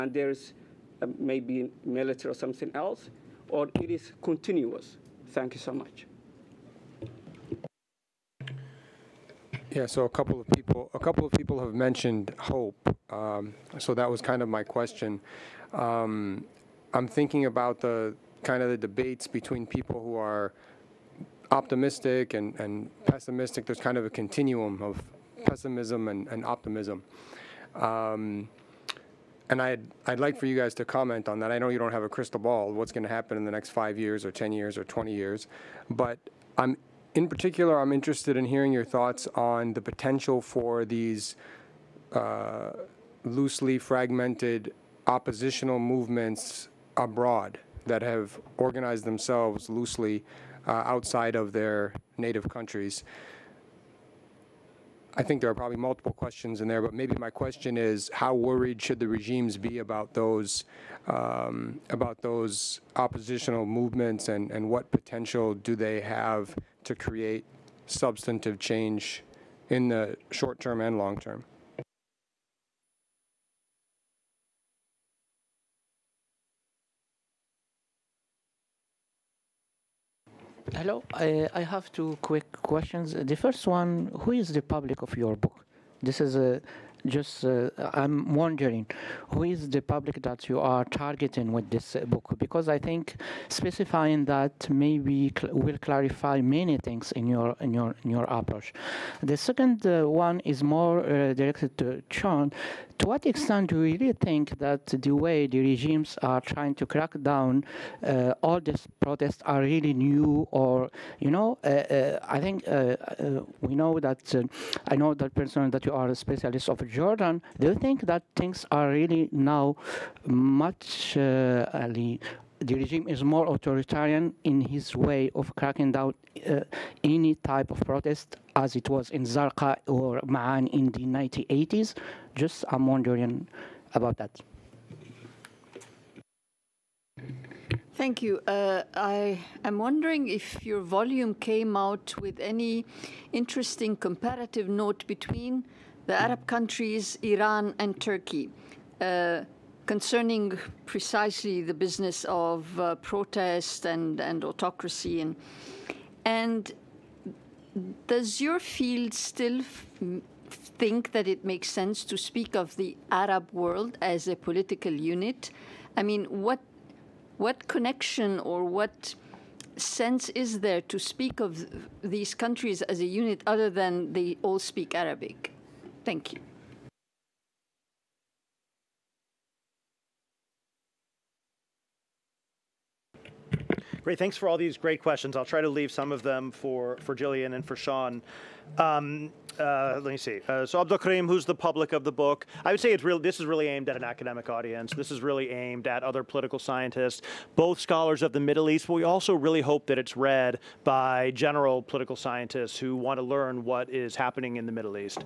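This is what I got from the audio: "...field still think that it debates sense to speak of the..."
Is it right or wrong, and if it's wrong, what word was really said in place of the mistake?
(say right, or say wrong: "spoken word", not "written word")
wrong: "makes", not "debates".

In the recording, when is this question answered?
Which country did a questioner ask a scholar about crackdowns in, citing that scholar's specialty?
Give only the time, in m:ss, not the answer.
1:56.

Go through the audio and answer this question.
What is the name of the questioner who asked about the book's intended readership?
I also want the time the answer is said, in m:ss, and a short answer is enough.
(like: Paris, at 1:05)
Abdul Karim, at 3:10.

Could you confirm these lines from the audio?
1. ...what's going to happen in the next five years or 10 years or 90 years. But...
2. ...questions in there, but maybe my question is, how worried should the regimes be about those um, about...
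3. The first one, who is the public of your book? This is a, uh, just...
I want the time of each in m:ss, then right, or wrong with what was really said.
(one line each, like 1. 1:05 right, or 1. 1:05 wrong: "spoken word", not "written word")
1. 0:32 wrong: "20", not "90"
2. 0:56 right
3. 1:23 right.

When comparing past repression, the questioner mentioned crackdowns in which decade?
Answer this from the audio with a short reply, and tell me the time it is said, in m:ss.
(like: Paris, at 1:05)
1980s, at 2:11.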